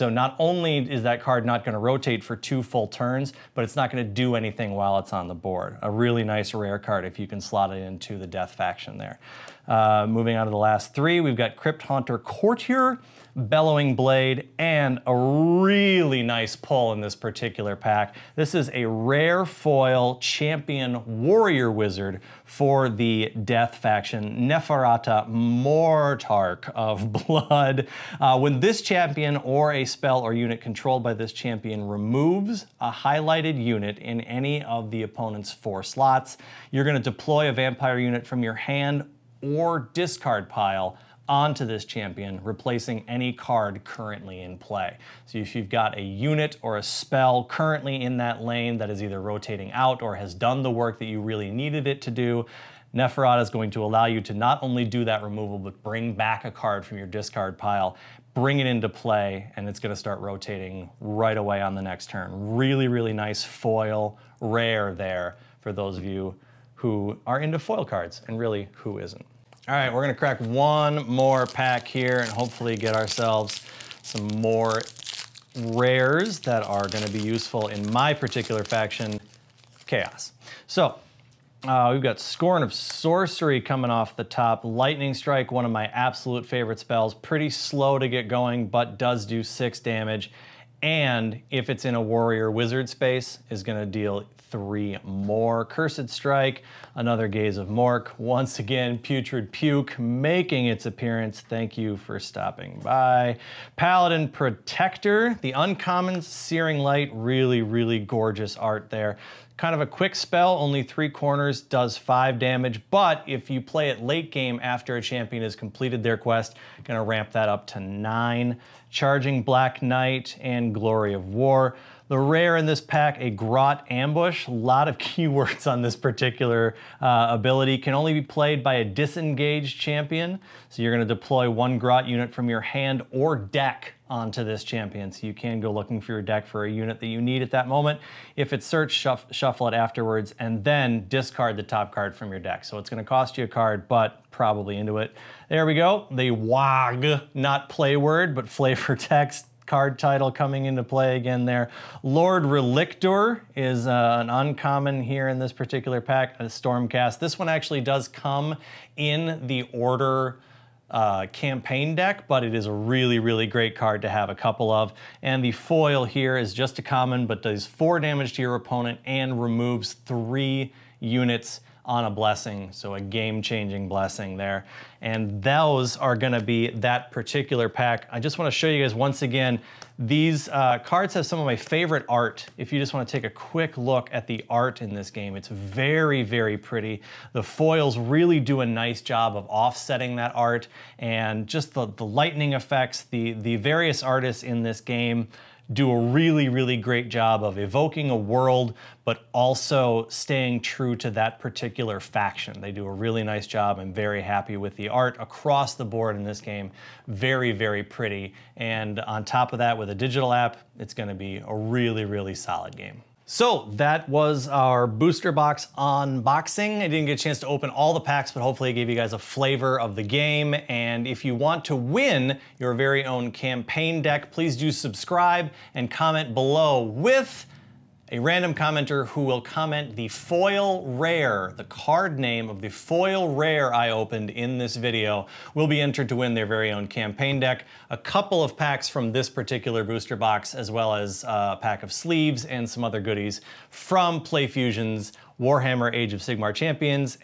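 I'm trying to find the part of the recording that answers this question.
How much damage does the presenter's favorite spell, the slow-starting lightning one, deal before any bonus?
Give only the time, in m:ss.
1:29.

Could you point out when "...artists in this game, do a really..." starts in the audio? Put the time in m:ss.
3:14.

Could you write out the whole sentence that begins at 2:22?
So it's gonna cost you a card, but probably into it.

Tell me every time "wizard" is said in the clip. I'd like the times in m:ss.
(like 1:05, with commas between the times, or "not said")
0:21, 1:32.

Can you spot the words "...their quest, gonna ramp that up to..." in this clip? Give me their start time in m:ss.
1:56.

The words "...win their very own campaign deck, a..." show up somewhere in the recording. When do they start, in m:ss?
3:56.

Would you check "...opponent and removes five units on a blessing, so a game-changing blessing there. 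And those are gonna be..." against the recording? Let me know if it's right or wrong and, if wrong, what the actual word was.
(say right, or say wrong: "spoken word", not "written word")
wrong: "three", not "five".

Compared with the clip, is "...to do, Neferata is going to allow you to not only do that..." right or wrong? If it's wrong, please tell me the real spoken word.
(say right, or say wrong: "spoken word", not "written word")
right.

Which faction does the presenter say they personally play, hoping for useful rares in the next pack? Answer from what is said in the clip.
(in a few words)
Chaos.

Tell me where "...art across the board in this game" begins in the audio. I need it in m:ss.
3:24.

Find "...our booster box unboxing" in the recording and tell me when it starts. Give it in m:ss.
3:34.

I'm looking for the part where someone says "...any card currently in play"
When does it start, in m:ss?
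0:43.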